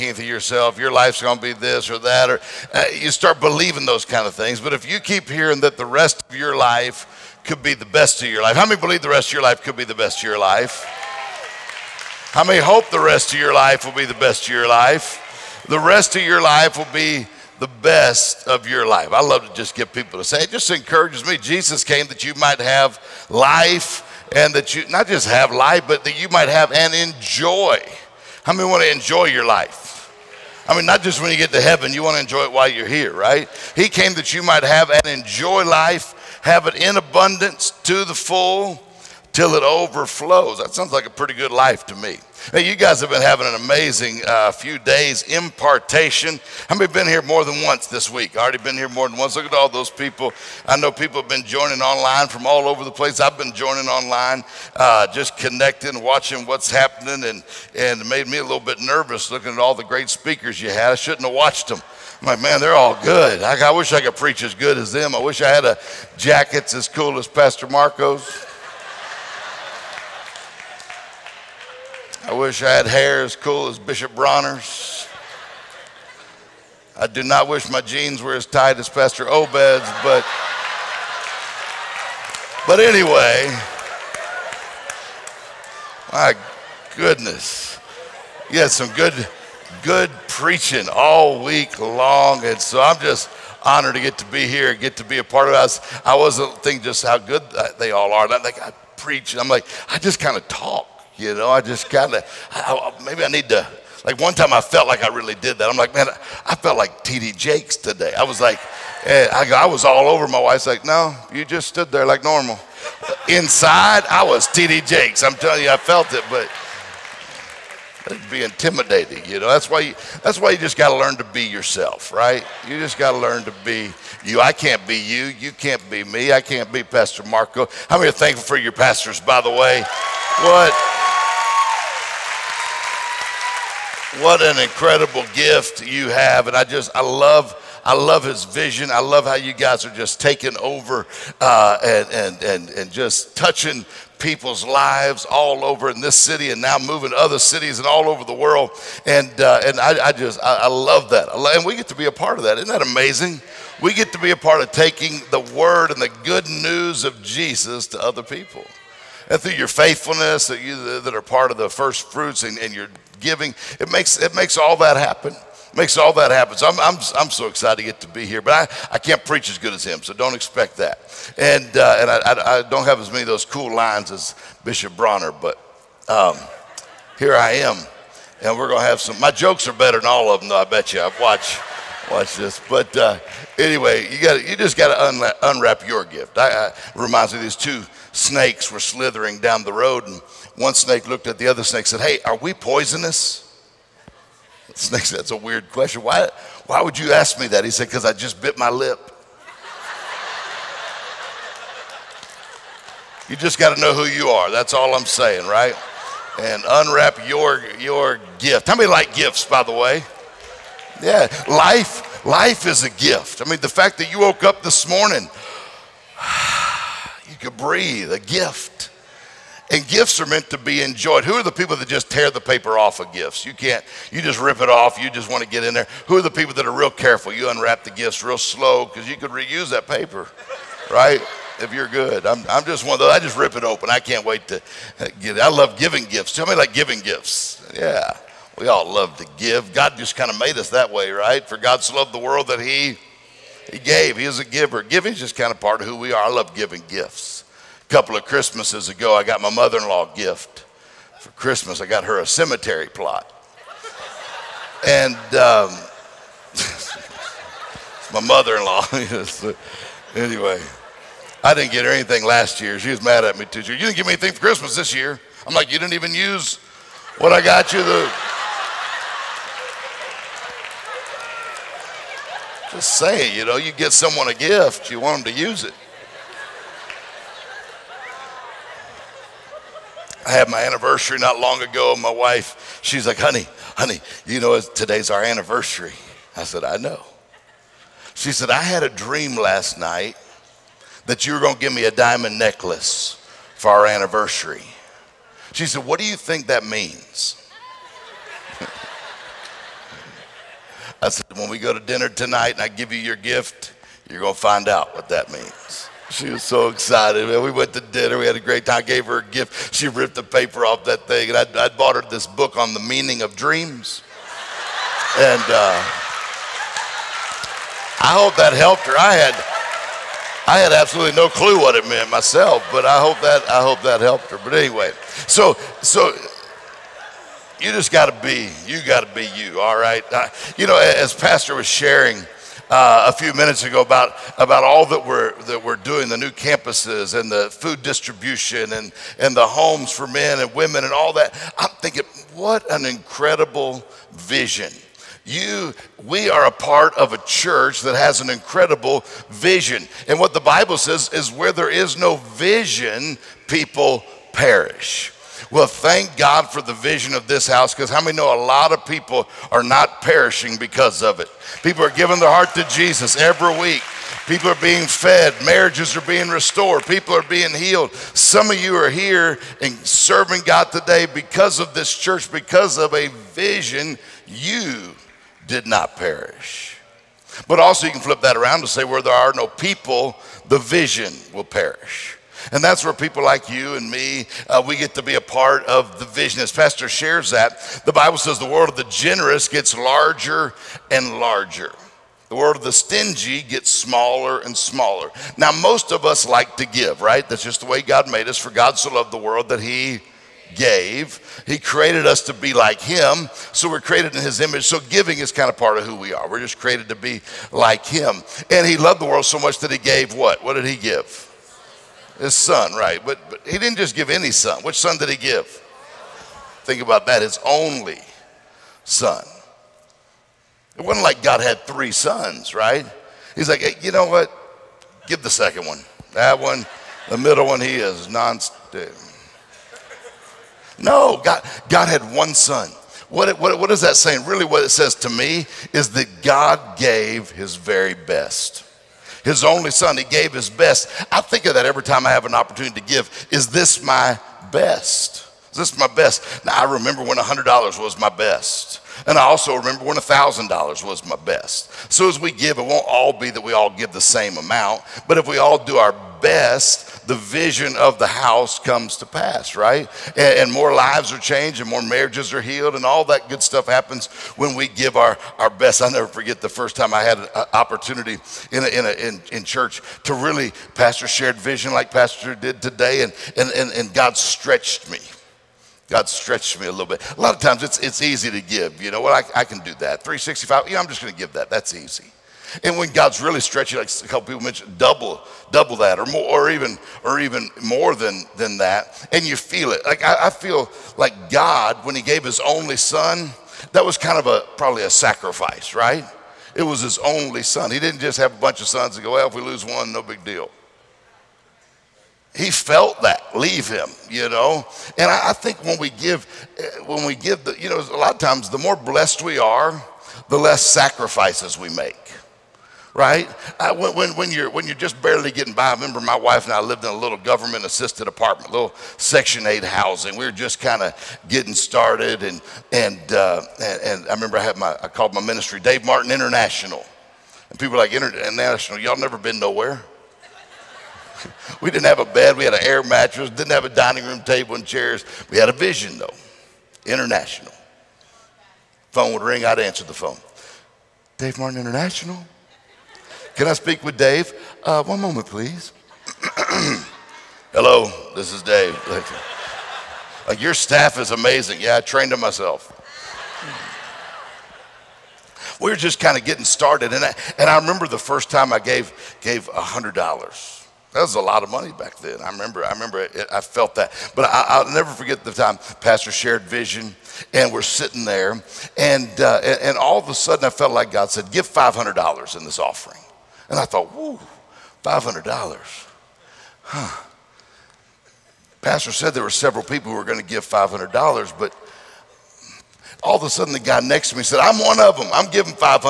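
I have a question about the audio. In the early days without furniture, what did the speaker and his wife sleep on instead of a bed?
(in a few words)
An air mattress.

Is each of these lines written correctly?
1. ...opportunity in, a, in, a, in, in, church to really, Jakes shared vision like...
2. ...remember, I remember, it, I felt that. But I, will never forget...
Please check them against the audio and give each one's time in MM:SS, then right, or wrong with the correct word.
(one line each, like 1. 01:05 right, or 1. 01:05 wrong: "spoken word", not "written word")
1. 07:47 wrong: "Pastor", not "Jakes"
2. 09:22 right.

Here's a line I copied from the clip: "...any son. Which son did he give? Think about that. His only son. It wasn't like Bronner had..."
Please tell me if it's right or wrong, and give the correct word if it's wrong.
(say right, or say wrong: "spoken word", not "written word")
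wrong: "God", not "Bronner".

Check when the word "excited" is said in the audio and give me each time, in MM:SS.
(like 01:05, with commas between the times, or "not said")
02:47, 05:06.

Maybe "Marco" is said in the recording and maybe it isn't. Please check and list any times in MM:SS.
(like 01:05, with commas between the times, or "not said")
01:07, 02:07.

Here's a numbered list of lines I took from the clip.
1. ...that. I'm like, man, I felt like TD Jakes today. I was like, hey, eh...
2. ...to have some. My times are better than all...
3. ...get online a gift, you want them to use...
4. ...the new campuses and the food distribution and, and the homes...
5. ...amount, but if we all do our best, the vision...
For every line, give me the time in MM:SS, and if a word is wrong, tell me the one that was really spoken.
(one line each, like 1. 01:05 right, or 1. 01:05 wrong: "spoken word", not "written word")
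1. 01:45 right
2. 02:58 wrong: "jokes", not "times"
3. 04:33 wrong: "someone", not "online"
4. 05:36 right
5. 07:34 right.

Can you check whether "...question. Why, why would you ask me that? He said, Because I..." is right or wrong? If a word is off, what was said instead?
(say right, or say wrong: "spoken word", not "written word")
right.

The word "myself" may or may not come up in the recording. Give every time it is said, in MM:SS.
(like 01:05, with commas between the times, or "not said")
05:22, 09:12.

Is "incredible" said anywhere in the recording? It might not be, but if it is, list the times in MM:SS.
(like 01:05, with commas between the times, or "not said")
02:14, 05:42, 05:48.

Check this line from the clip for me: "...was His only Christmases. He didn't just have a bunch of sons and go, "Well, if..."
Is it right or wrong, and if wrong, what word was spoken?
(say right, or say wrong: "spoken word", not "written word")
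wrong: "Son", not "Christmases".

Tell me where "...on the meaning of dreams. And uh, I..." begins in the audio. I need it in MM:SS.
05:12.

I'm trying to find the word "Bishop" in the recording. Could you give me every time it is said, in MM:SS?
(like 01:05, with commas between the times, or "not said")
01:13, 02:54.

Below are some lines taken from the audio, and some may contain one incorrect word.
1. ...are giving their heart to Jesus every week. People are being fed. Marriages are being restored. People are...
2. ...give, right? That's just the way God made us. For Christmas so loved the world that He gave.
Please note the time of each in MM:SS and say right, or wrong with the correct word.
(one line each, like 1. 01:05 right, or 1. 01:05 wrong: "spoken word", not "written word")
1. 06:01 right
2. 06:36 wrong: "God", not "Christmas".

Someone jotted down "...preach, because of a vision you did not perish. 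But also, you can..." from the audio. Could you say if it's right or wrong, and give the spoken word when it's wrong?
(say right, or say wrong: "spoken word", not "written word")
wrong: "church", not "preach".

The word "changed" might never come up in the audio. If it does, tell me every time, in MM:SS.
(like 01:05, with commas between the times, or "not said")
07:41.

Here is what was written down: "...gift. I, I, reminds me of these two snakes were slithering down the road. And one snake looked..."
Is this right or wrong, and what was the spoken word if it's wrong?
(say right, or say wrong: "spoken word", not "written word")
right.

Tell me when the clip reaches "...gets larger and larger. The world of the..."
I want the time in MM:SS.
06:29.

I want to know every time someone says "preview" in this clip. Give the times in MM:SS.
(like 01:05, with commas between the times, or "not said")
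not said.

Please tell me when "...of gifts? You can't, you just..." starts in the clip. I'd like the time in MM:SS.
03:42.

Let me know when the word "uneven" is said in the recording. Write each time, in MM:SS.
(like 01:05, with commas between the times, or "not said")
not said.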